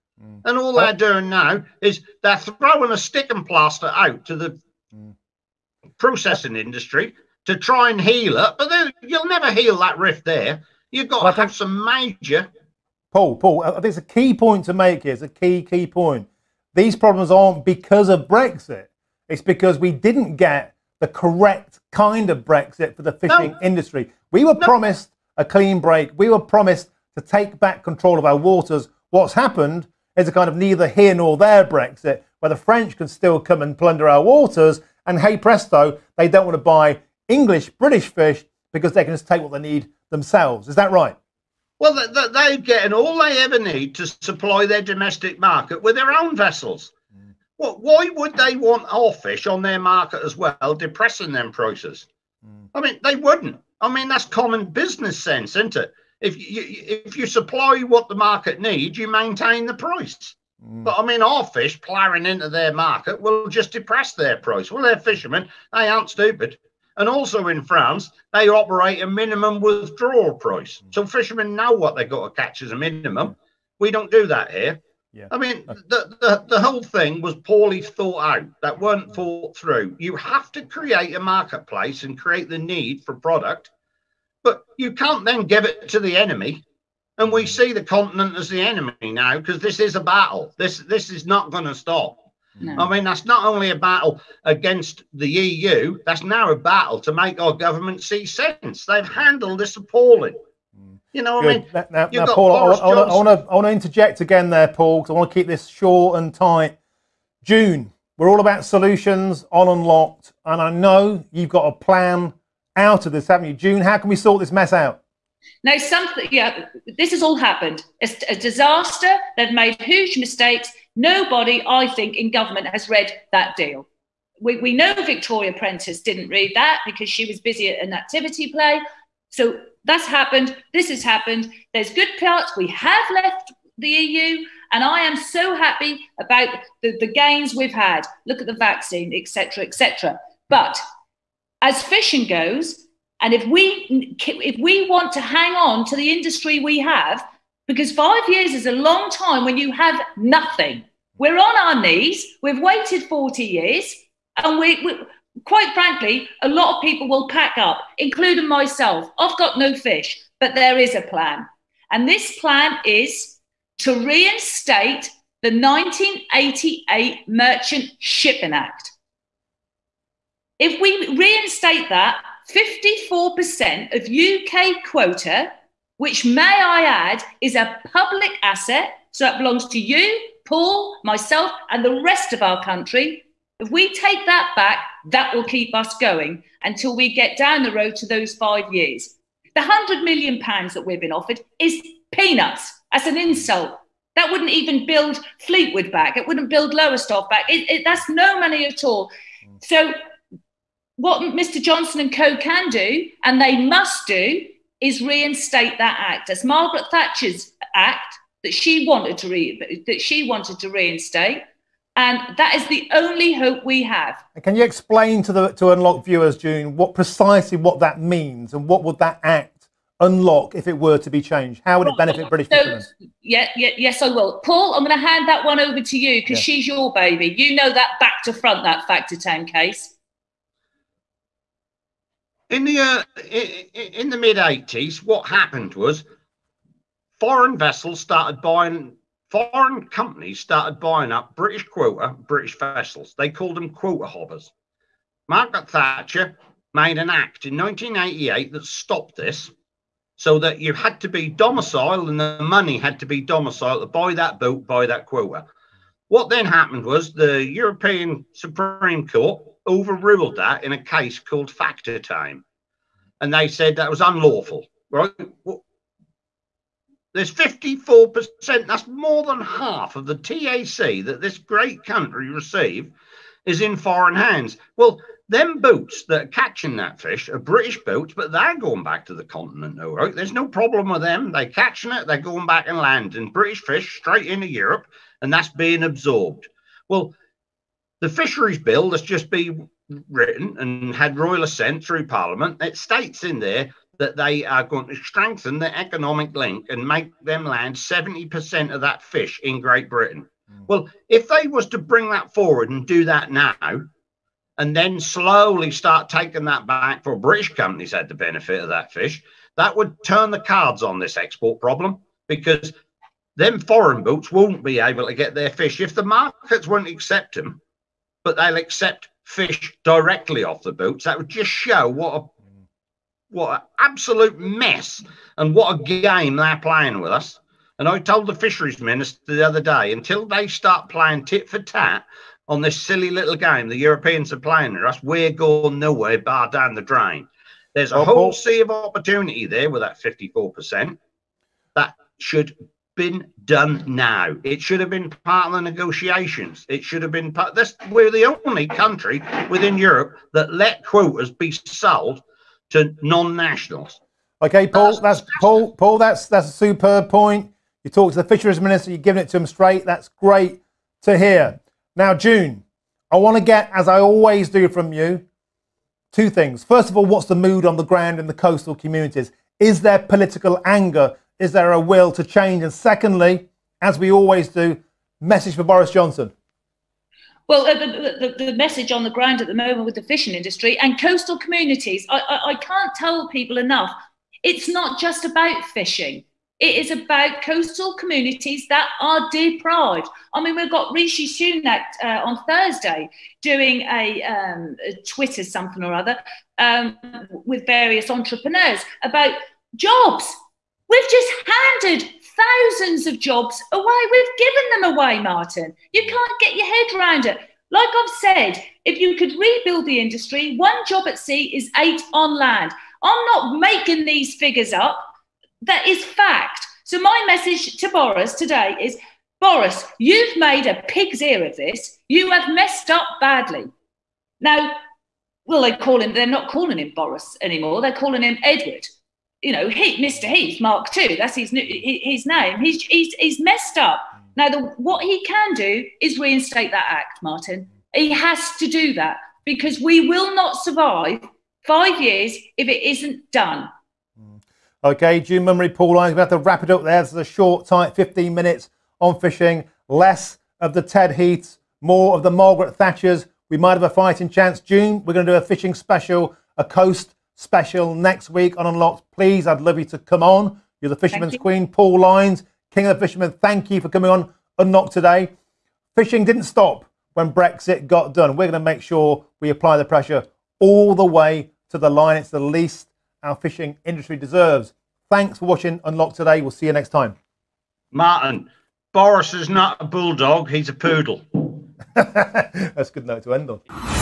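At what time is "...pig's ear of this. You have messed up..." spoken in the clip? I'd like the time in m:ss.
7:00.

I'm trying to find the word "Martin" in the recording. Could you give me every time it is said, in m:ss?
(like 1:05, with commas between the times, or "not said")
6:45, 7:17, 7:57.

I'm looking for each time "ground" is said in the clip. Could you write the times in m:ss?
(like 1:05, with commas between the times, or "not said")
6:07, 6:19.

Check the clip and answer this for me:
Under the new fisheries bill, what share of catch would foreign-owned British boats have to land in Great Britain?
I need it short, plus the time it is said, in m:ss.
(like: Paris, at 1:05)
70%, at 4:57.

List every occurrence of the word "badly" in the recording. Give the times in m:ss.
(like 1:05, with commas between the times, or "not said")
7:03.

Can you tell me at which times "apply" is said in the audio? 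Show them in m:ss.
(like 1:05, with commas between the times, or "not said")
7:49.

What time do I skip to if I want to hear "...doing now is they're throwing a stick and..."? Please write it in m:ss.
0:00.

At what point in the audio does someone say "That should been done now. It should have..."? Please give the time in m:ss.
5:41.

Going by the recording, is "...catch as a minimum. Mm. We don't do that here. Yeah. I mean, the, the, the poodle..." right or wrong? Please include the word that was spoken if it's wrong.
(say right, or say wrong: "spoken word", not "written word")
wrong: "whole", not "poodle".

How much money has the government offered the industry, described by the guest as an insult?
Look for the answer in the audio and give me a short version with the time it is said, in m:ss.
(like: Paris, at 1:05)
£100 million, at 3:09.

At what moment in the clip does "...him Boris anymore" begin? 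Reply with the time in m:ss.
7:06.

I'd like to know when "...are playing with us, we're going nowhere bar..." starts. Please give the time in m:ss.
5:34.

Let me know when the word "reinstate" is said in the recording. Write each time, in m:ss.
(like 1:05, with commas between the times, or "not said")
2:44, 2:51, 3:25, 3:30, 7:16.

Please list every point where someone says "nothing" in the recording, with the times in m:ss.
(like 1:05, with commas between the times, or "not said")
2:30.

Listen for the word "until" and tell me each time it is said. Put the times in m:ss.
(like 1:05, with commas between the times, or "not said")
3:06, 5:29.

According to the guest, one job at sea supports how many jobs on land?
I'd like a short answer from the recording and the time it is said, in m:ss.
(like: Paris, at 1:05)
8, at 6:51.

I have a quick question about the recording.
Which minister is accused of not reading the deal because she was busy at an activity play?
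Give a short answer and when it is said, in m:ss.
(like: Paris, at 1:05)
Victoria Prentice, at 2:04.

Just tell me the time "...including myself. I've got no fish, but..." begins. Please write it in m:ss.
2:37.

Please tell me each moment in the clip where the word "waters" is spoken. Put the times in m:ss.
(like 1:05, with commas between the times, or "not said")
0:28, 0:34.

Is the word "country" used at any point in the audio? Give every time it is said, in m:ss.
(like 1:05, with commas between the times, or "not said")
3:02, 4:31, 5:48.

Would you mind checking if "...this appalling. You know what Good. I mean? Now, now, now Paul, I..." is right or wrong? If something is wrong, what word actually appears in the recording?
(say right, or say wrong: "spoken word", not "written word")
right.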